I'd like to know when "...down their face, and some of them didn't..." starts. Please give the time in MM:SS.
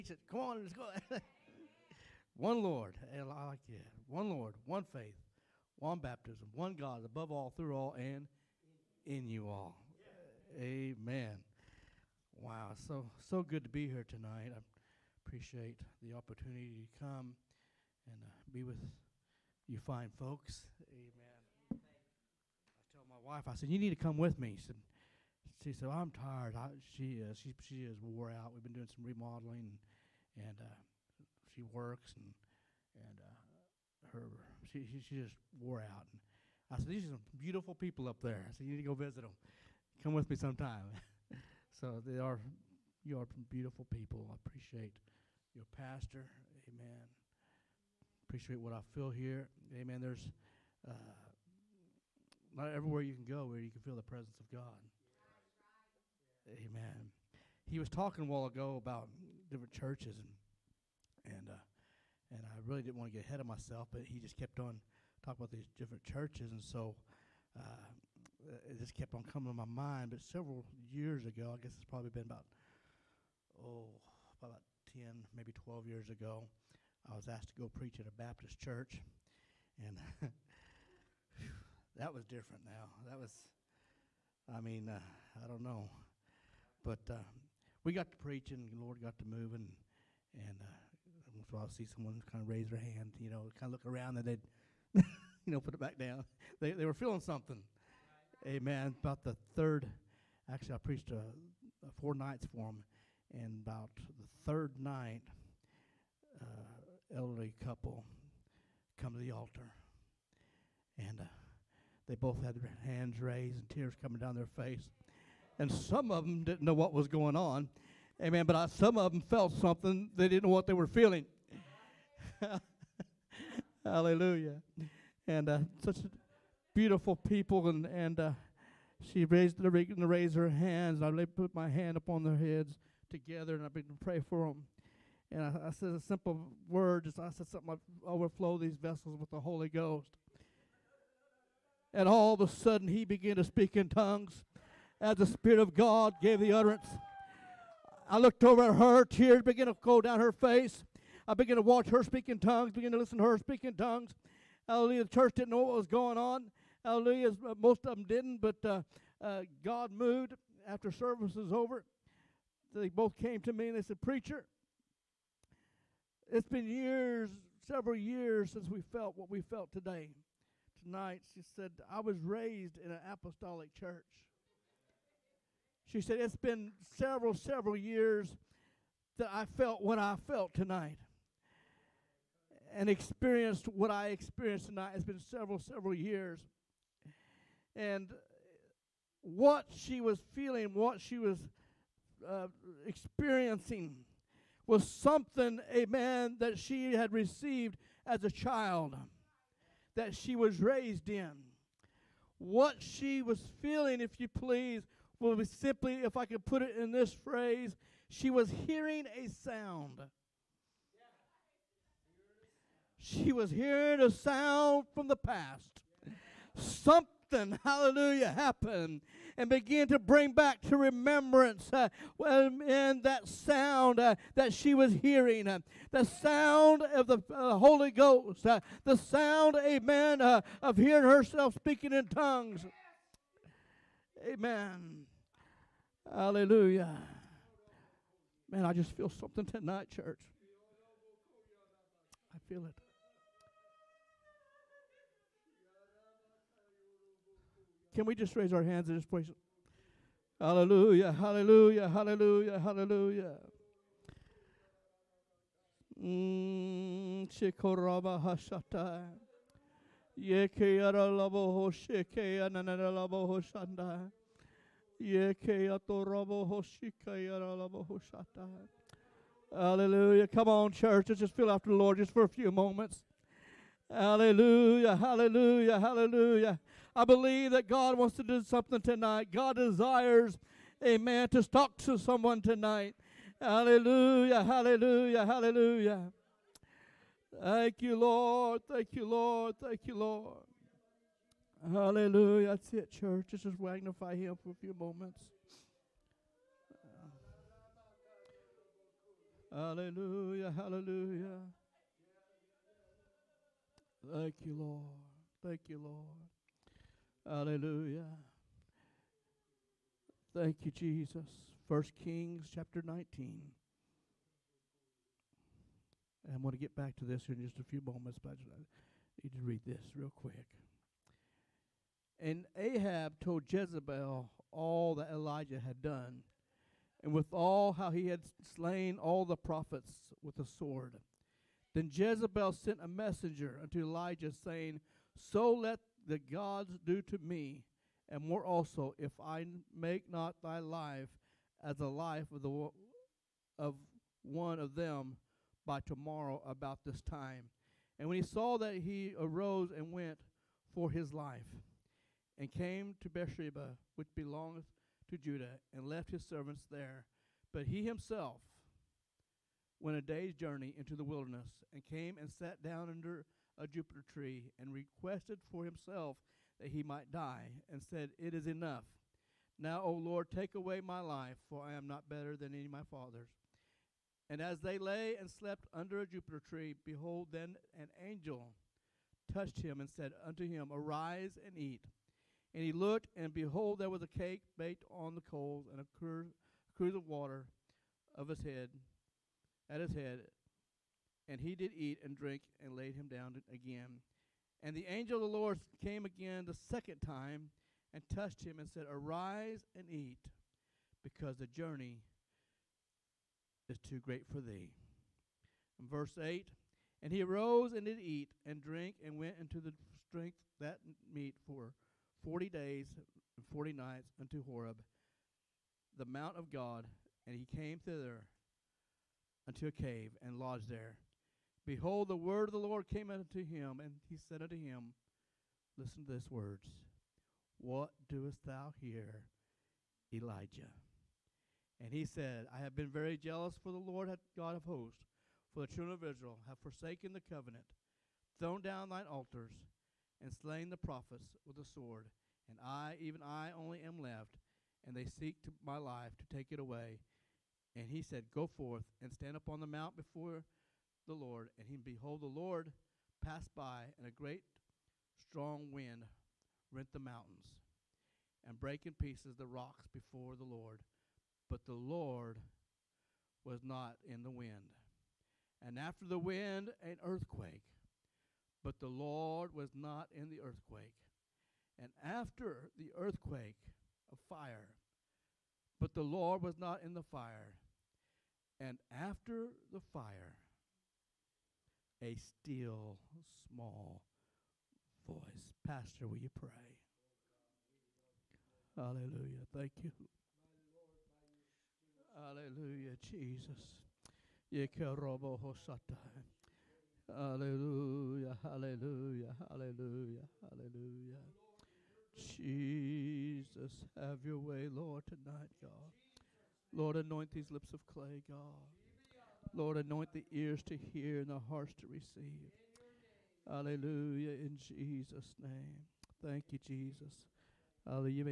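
01:54.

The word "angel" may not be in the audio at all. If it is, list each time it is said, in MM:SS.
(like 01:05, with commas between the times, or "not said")
06:18, 06:34.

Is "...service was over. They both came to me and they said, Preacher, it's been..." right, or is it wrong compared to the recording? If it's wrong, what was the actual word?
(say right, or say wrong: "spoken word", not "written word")
right.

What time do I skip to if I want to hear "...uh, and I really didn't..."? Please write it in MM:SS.
01:01.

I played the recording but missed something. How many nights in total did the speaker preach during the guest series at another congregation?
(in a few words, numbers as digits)
4.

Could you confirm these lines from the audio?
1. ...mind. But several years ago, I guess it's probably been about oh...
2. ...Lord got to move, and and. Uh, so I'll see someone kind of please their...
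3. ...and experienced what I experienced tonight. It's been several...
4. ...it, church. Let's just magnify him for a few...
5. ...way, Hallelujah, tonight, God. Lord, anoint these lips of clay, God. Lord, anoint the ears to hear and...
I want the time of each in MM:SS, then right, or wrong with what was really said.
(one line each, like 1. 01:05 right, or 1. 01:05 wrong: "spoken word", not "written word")
1. 01:09 right
2. 01:28 wrong: "raise", not "please"
3. 03:02 right
4. 04:52 right
5. 08:24 wrong: "Lord", not "Hallelujah".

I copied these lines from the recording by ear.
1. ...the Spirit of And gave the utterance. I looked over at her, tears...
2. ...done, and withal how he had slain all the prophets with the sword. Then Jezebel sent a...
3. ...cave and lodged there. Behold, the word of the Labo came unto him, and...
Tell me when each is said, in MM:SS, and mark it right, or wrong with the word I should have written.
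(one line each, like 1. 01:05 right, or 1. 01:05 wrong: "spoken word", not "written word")
1. 02:25 wrong: "God", not "And"
2. 05:25 right
3. 06:59 wrong: "Lord", not "Labo".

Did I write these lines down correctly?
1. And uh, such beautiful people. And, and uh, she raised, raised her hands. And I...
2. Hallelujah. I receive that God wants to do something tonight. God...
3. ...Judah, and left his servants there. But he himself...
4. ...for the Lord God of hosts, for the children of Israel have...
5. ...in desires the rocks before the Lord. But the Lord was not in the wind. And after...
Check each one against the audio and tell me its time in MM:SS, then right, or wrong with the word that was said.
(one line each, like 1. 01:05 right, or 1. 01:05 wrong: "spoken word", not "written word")
1. 02:05 right
2. 04:35 wrong: "believe", not "receive"
3. 05:55 right
4. 07:13 right
5. 07:38 wrong: "pieces", not "desires".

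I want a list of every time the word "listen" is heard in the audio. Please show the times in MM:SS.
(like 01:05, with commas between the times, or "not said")
02:32, 07:05.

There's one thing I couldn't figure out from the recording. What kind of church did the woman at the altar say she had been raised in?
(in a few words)
Apostolic.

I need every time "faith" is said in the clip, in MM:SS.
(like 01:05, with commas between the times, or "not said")
00:04.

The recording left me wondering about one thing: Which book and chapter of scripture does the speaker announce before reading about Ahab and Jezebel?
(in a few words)
First Kings 19.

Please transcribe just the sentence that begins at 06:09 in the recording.
Now, O Lord, take away my life, for I am not better than any of my fathers.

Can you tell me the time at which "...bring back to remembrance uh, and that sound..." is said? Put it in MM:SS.
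03:39.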